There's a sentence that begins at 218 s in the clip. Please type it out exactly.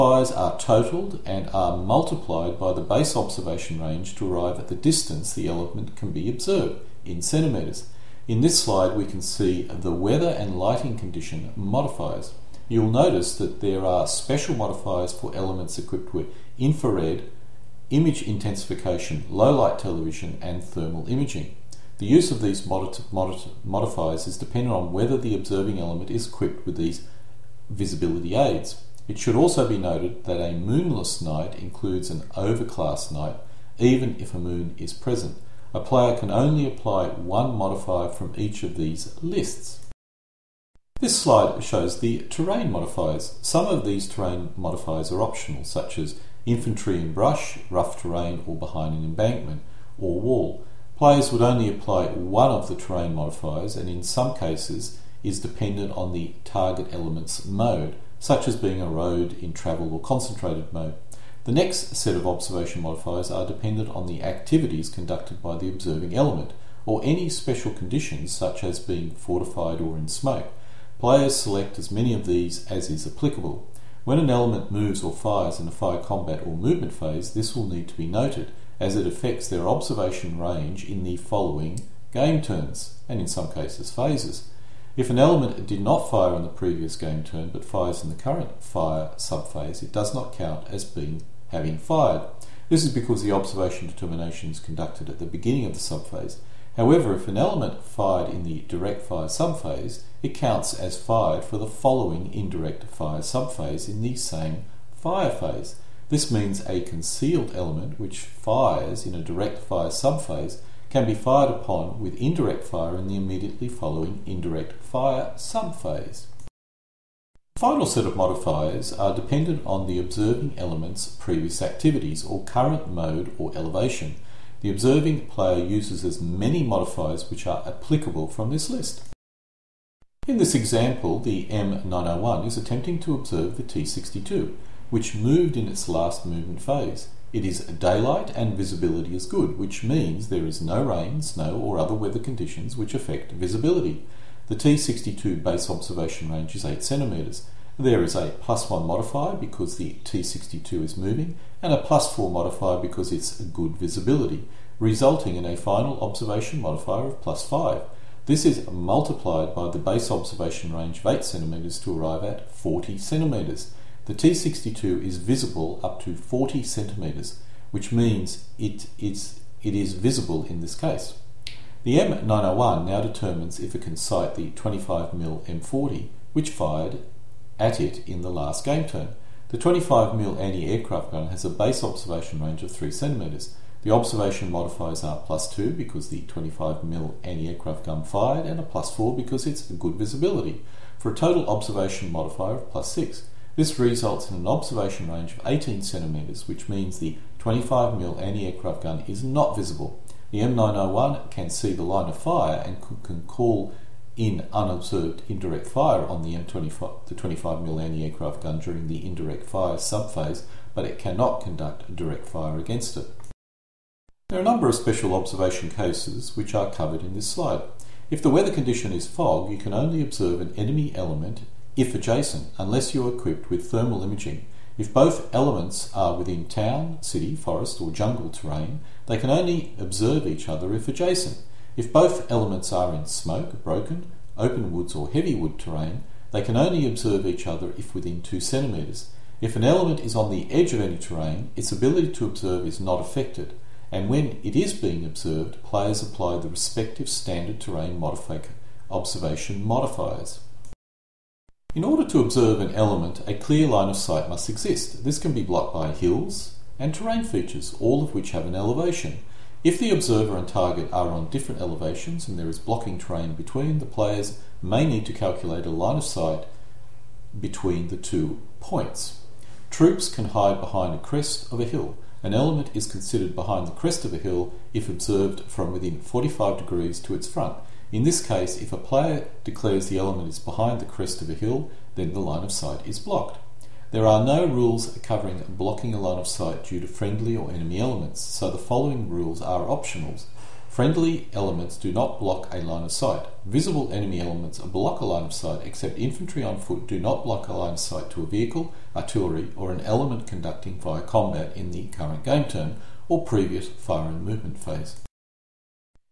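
If the weather condition is fog, you can only observe an enemy element if adjacent, unless you are equipped with thermal imaging.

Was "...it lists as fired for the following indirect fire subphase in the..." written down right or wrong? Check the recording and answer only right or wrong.
wrong.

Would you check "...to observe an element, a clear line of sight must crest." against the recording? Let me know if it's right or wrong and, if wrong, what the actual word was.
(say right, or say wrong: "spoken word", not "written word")
wrong: "exist", not "crest".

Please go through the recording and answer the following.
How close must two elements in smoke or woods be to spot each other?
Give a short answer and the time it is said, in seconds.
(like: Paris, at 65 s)
2 centimetres, at 238 s.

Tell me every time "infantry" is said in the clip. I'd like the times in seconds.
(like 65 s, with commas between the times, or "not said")
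46 s, 295 s.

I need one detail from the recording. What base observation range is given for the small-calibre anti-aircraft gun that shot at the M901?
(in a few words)
3cm.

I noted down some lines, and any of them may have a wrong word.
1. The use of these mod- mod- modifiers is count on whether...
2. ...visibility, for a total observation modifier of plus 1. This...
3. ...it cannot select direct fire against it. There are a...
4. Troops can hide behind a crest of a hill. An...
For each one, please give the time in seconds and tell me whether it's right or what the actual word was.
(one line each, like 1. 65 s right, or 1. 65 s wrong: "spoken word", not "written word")
1. 21 s wrong: "dependent", not "count"
2. 189 s wrong: "6", not "1"
3. 210 s wrong: "conduct", not "select"
4. 269 s right.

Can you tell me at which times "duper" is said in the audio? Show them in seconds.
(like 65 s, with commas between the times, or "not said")
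not said.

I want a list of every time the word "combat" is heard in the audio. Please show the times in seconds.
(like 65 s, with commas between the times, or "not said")
75 s, 301 s.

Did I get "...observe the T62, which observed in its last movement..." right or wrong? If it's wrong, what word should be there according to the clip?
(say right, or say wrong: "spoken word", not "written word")
wrong: "moved", not "observed".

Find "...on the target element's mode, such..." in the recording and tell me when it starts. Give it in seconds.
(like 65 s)
55 s.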